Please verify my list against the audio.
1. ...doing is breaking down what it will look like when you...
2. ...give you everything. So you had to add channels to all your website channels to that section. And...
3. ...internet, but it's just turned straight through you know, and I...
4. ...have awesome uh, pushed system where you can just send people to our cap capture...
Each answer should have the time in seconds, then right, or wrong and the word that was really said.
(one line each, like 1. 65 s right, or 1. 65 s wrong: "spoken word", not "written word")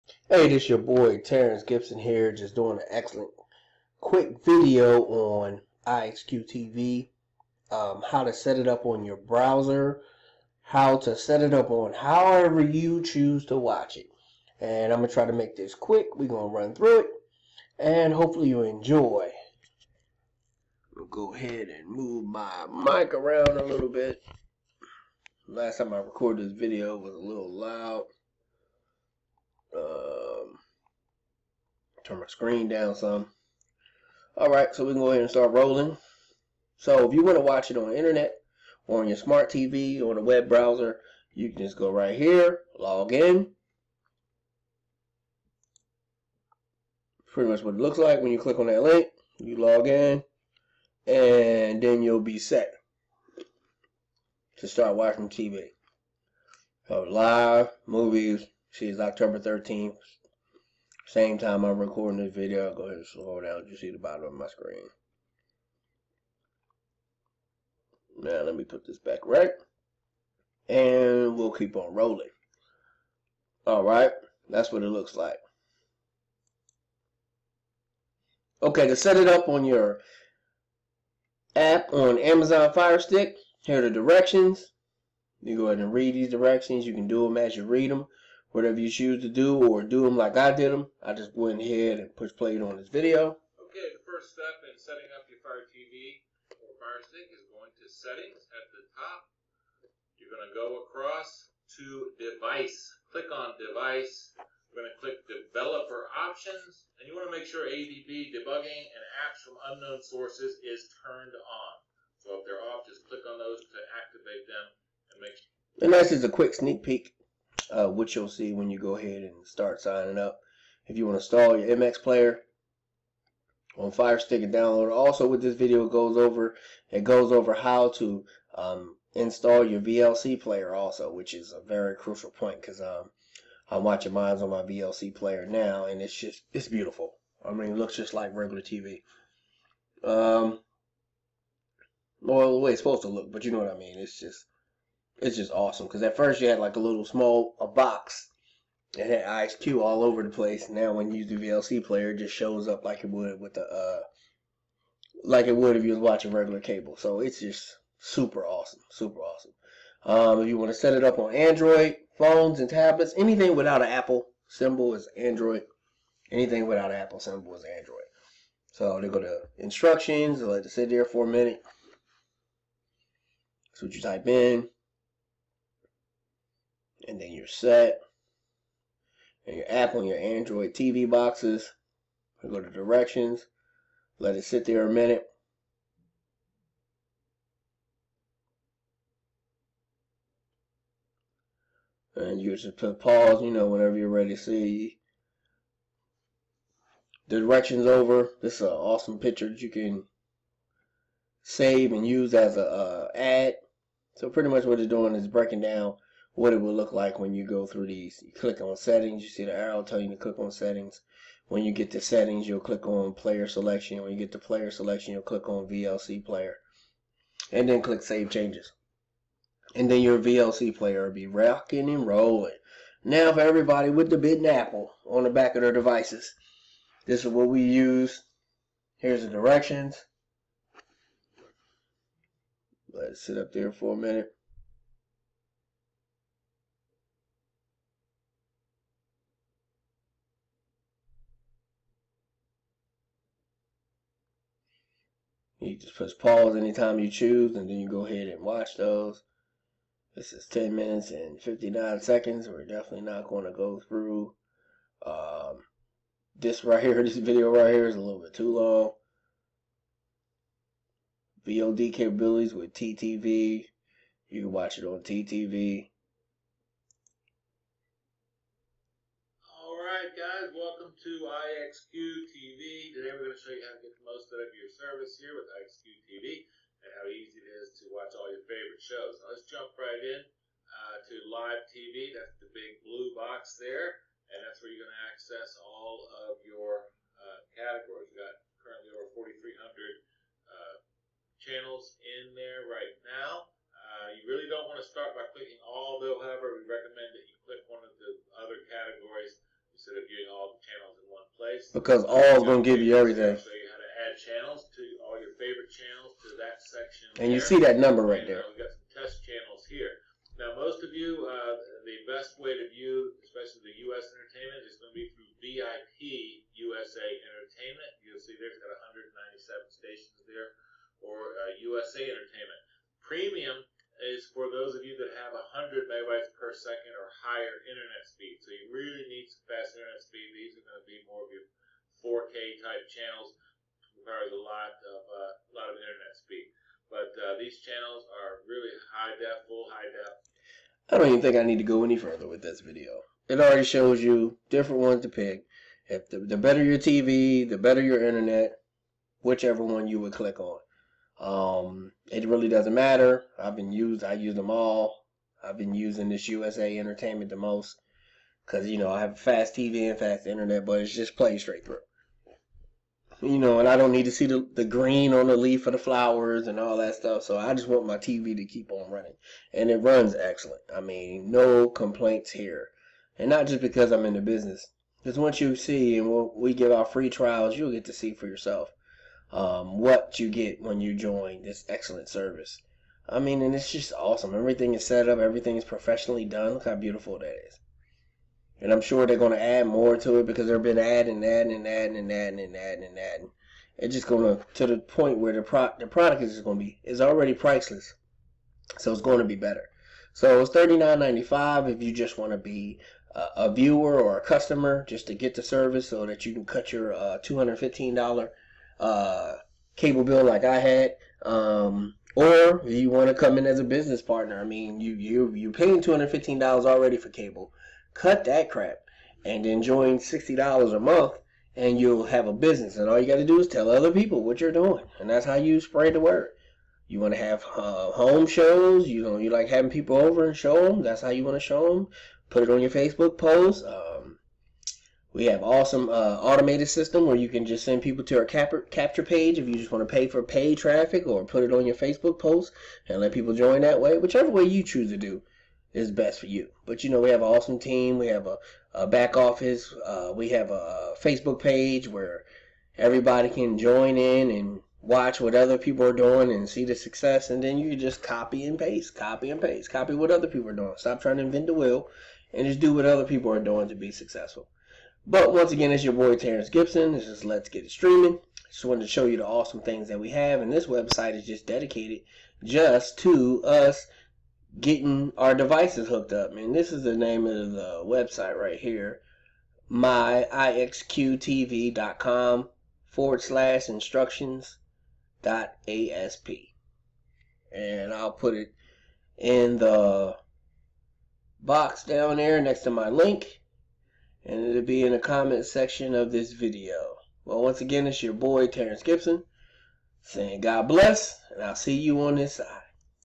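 1. 204 s right
2. 302 s wrong: "favorite", not "website"
3. 360 s wrong: "played", not "turned"
4. 435 s wrong: "automated", not "pushed".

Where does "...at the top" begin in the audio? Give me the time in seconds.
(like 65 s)
98 s.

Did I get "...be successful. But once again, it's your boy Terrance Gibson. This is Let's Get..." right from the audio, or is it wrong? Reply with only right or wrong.
right.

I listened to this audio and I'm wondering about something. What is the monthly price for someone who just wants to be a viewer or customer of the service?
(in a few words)
$39.95.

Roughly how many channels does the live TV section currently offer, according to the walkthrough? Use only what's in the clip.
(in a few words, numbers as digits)
4,300.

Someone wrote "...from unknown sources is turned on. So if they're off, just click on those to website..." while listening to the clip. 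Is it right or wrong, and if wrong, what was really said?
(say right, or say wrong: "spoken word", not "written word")
wrong: "activate", not "website".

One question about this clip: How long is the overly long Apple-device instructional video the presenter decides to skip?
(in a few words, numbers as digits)
10 minutes 59 seconds.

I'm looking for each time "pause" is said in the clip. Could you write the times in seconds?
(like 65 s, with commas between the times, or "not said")
192 s, 246 s.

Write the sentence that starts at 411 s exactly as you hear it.
Um, or you want to come in as a business partner.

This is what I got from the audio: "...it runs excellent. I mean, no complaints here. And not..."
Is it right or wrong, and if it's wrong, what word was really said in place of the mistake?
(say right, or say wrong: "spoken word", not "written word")
right.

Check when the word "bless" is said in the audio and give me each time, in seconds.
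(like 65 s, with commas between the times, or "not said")
500 s.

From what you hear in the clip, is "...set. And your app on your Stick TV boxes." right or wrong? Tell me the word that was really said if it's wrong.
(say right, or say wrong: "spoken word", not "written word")
wrong: "Android", not "Stick".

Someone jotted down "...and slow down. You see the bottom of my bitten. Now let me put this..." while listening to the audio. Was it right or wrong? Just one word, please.
wrong.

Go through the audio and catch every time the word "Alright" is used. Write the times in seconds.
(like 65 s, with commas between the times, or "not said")
34 s, 73 s.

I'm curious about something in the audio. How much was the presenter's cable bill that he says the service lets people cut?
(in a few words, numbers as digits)
$215.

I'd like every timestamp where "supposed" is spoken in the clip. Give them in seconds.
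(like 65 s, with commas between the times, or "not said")
142 s.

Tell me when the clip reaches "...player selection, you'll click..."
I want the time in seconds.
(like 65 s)
214 s.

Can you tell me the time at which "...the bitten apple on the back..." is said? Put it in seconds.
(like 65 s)
224 s.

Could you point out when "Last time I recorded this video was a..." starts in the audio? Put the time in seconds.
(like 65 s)
25 s.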